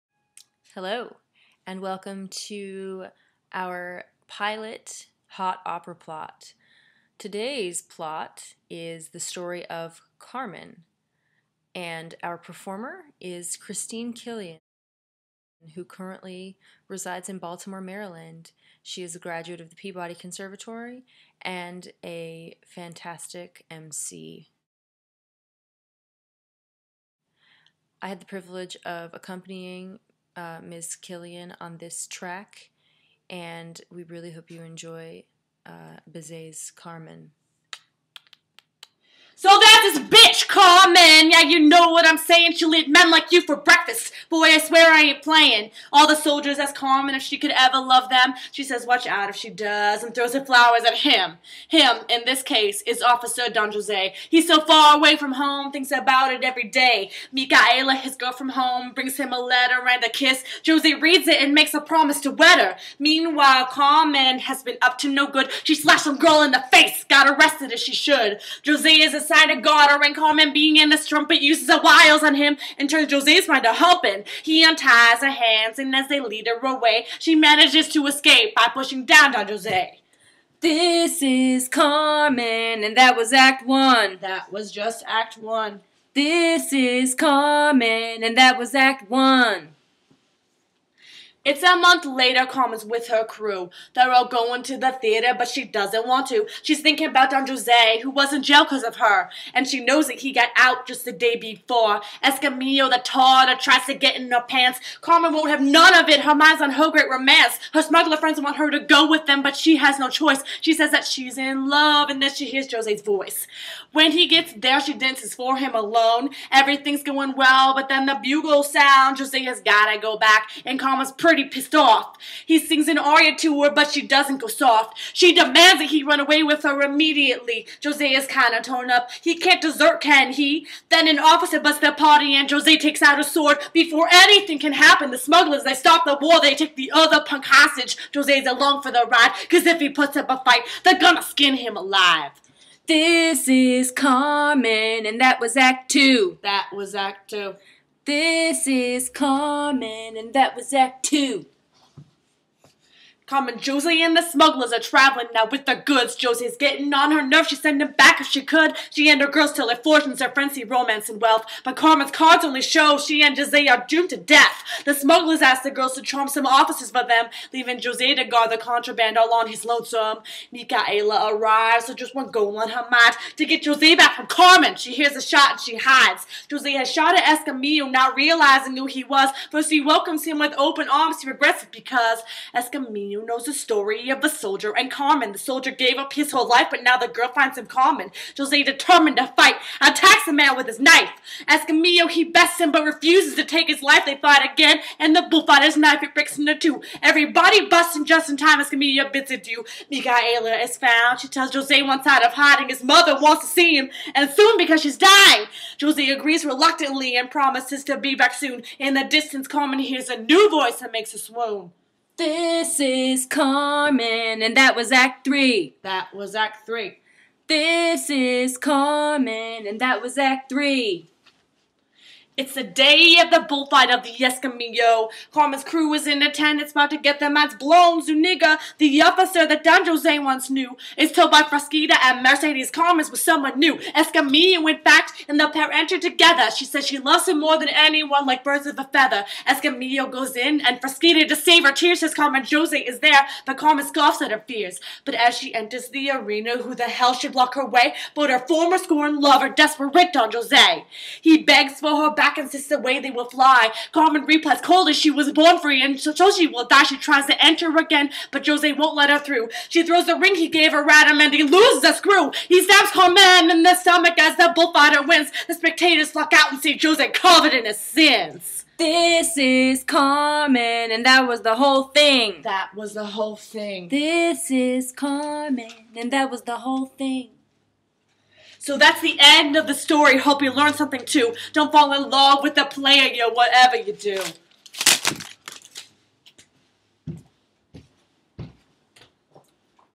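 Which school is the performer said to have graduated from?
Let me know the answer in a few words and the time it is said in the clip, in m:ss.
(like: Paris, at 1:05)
Peabody Conservatory, at 0:19.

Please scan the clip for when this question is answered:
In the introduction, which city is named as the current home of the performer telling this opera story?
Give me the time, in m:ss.
0:17.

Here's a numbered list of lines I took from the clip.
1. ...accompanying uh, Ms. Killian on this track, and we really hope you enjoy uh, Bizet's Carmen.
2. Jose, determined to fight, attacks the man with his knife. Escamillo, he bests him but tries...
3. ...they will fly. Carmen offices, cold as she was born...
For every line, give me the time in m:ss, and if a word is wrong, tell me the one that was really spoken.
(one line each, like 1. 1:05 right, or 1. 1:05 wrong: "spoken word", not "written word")
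1. 0:29 right
2. 3:08 wrong: "refuses", not "tries"
3. 4:12 wrong: "replies", not "offices".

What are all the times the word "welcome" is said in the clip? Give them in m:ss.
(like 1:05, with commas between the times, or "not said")
0:01, 2:59.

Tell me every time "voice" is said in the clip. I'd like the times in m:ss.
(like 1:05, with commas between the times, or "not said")
1:53, 3:30.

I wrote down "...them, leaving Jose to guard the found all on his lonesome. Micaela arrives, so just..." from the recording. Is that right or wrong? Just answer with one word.
wrong.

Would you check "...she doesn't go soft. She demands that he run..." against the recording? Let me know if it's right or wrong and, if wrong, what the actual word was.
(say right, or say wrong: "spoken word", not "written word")
right.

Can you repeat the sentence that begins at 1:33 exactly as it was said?
They're all going to the theater, but she doesn't want to.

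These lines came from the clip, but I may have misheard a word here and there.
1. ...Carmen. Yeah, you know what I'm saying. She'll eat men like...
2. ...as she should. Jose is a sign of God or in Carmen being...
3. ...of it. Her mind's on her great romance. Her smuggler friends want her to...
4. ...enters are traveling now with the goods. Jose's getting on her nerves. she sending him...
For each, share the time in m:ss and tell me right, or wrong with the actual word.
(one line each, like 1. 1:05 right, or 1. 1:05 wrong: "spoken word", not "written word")
1. 0:40 right
2. 1:07 right
3. 1:45 right
4. 2:34 wrong: "smugglers", not "enters".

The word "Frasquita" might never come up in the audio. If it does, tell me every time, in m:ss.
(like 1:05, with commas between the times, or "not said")
3:51, 4:00.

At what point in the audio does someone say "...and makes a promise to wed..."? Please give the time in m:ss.
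1:01.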